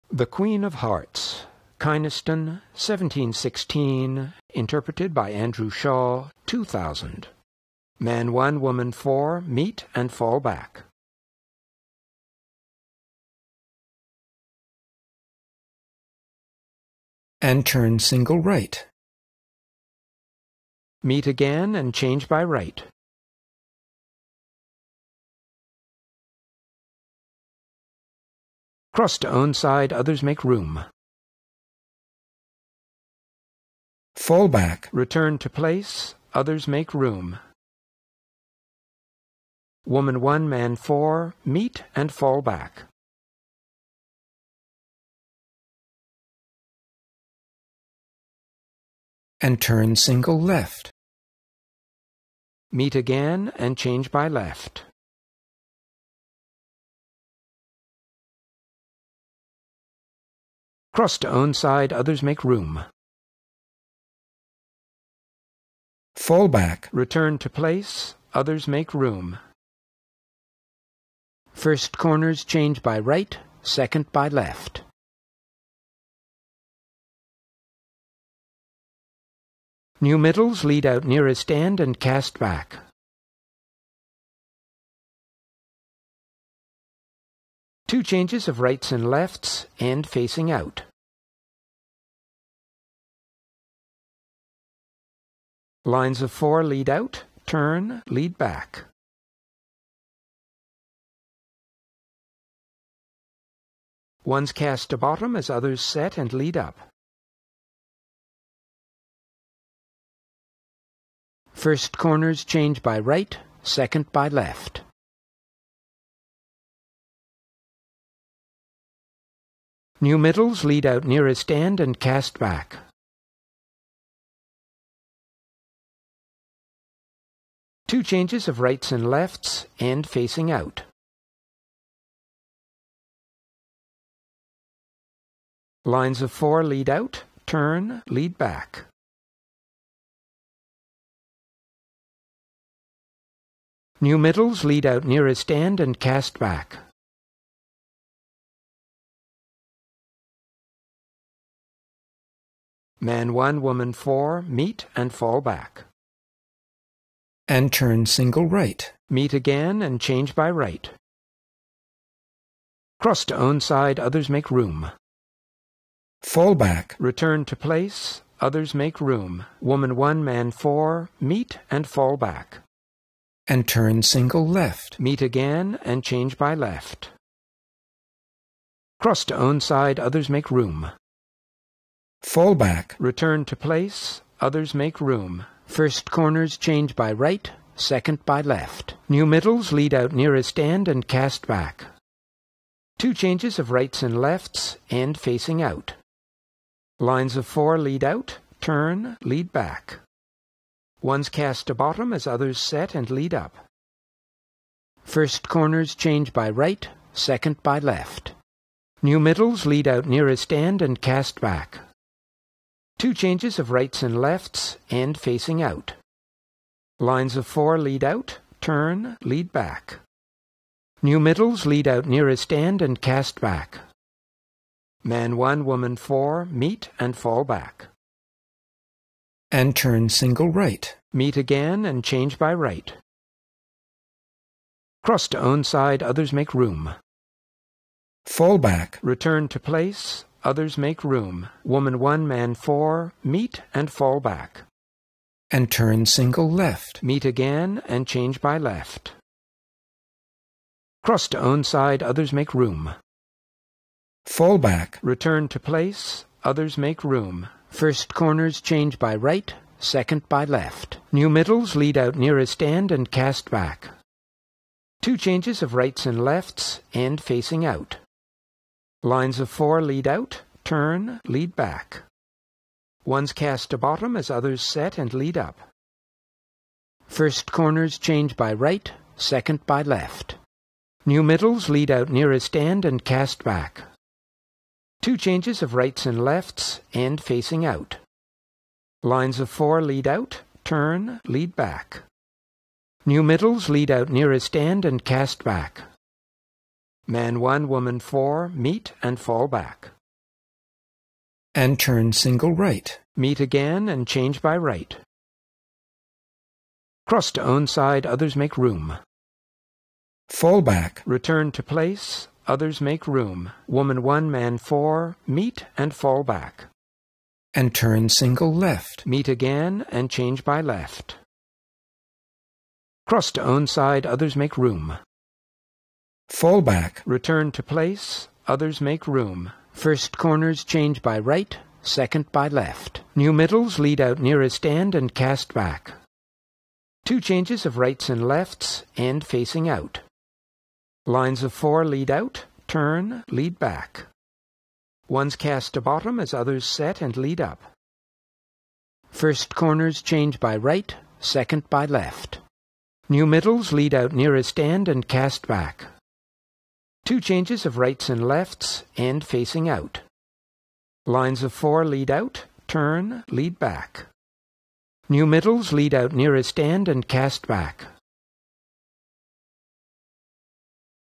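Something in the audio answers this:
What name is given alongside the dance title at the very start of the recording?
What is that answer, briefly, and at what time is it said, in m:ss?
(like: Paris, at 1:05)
Kynaston, at 0:01.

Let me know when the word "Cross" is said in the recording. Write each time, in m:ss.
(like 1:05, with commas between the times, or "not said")
0:28, 1:00, 2:42, 2:58, 3:55, 4:11, 5:07, 5:23.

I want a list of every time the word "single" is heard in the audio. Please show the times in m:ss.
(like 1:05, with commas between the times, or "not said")
0:17, 0:49, 2:38, 2:54, 3:50, 4:06, 5:02, 5:18.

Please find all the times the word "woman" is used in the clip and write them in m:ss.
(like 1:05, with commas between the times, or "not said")
0:08, 0:39, 2:33, 2:49, 3:45, 4:01, 4:57, 5:13.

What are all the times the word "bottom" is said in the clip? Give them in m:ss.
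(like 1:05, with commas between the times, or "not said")
1:44, 3:21, 4:33, 5:45.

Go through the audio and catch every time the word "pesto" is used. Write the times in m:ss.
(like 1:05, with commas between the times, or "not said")
not said.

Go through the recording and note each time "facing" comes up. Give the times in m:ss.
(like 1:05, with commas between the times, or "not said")
1:30, 2:10, 3:15, 3:35, 4:27, 4:47, 5:39, 5:59.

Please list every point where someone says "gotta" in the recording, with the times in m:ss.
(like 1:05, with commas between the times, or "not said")
not said.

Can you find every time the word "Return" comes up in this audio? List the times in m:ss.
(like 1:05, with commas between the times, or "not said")
0:34, 1:06, 2:46, 3:02, 3:59, 4:15, 5:11, 5:27.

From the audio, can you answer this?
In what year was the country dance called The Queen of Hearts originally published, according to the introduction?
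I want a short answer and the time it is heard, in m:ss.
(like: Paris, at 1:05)
1716, at 0:02.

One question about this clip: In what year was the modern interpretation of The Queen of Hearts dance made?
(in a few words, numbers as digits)
2000.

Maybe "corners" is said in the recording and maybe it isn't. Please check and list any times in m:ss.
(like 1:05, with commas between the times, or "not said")
1:11, 1:51, 3:06, 3:25, 4:18, 4:37, 5:30, 5:49.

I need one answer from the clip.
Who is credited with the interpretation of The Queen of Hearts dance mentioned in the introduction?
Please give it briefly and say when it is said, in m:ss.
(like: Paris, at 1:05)
Andrew Shaw, at 0:05.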